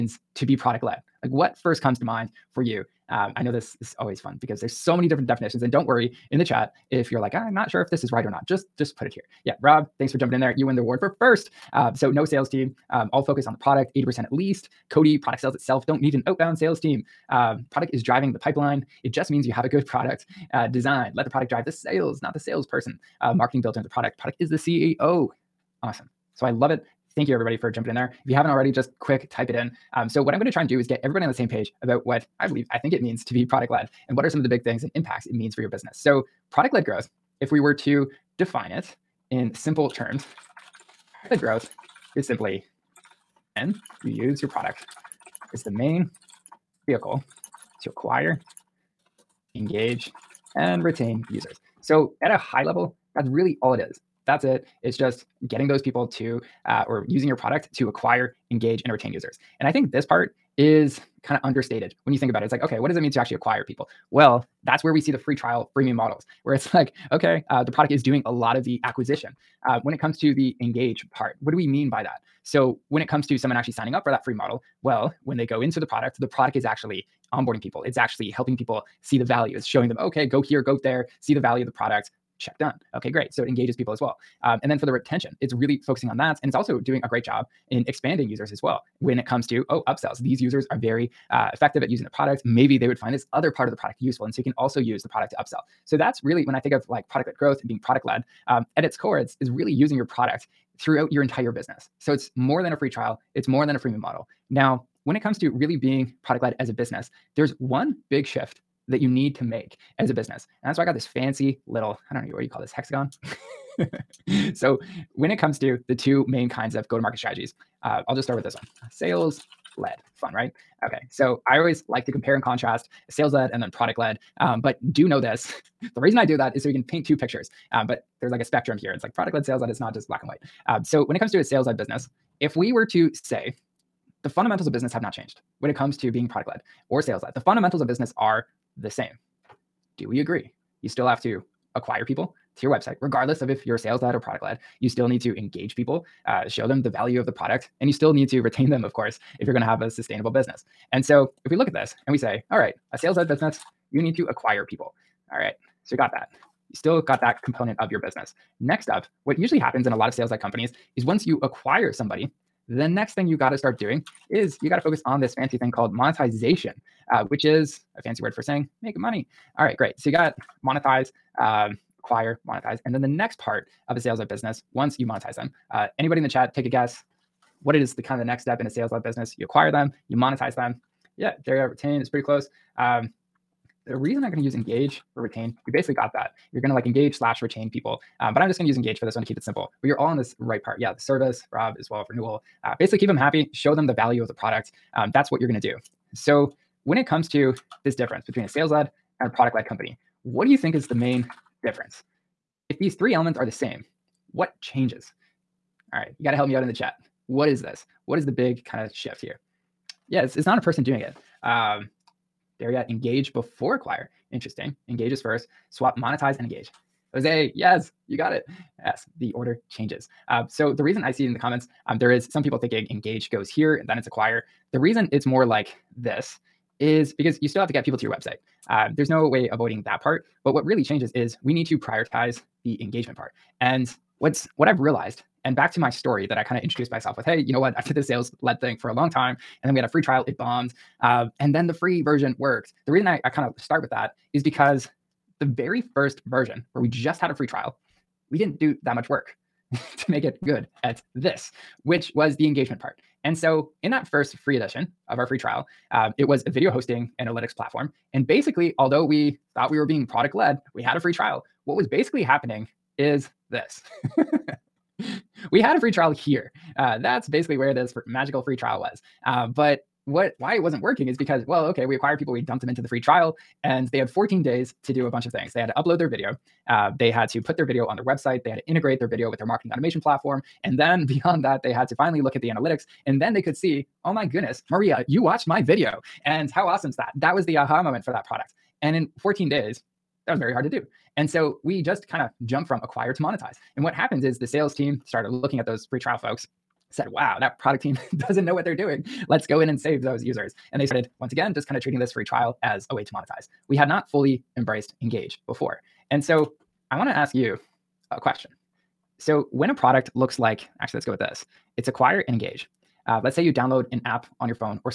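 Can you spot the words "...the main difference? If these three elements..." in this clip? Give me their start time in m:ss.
3:20.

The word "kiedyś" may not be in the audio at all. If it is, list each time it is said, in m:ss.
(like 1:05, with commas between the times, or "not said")
not said.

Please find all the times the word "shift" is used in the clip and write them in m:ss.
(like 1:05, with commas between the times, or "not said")
1:48, 3:28.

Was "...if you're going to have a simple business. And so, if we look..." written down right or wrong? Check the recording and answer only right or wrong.
wrong.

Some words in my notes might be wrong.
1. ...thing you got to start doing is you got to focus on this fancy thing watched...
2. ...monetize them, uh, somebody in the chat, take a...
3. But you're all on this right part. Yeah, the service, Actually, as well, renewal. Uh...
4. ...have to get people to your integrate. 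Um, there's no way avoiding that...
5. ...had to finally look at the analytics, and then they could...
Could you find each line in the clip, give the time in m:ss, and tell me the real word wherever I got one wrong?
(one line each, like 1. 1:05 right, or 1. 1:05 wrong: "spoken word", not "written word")
1. 2:43 wrong: "called", not "watched"
2. 2:55 wrong: "anybody", not "somebody"
3. 3:09 wrong: "Rob", not "Actually"
4. 3:47 wrong: "website", not "integrate"
5. 4:41 right.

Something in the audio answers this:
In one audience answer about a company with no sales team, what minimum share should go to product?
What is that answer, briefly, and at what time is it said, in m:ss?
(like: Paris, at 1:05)
80%, at 0:13.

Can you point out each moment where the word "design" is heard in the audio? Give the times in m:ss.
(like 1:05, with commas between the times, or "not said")
0:20.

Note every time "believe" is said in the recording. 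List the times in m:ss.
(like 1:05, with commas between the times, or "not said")
0:32.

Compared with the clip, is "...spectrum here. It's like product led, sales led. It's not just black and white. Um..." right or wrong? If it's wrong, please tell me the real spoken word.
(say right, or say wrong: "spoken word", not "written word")
right.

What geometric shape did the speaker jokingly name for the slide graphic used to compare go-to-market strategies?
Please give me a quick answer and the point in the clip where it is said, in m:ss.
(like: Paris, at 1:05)
hexagon, at 1:52.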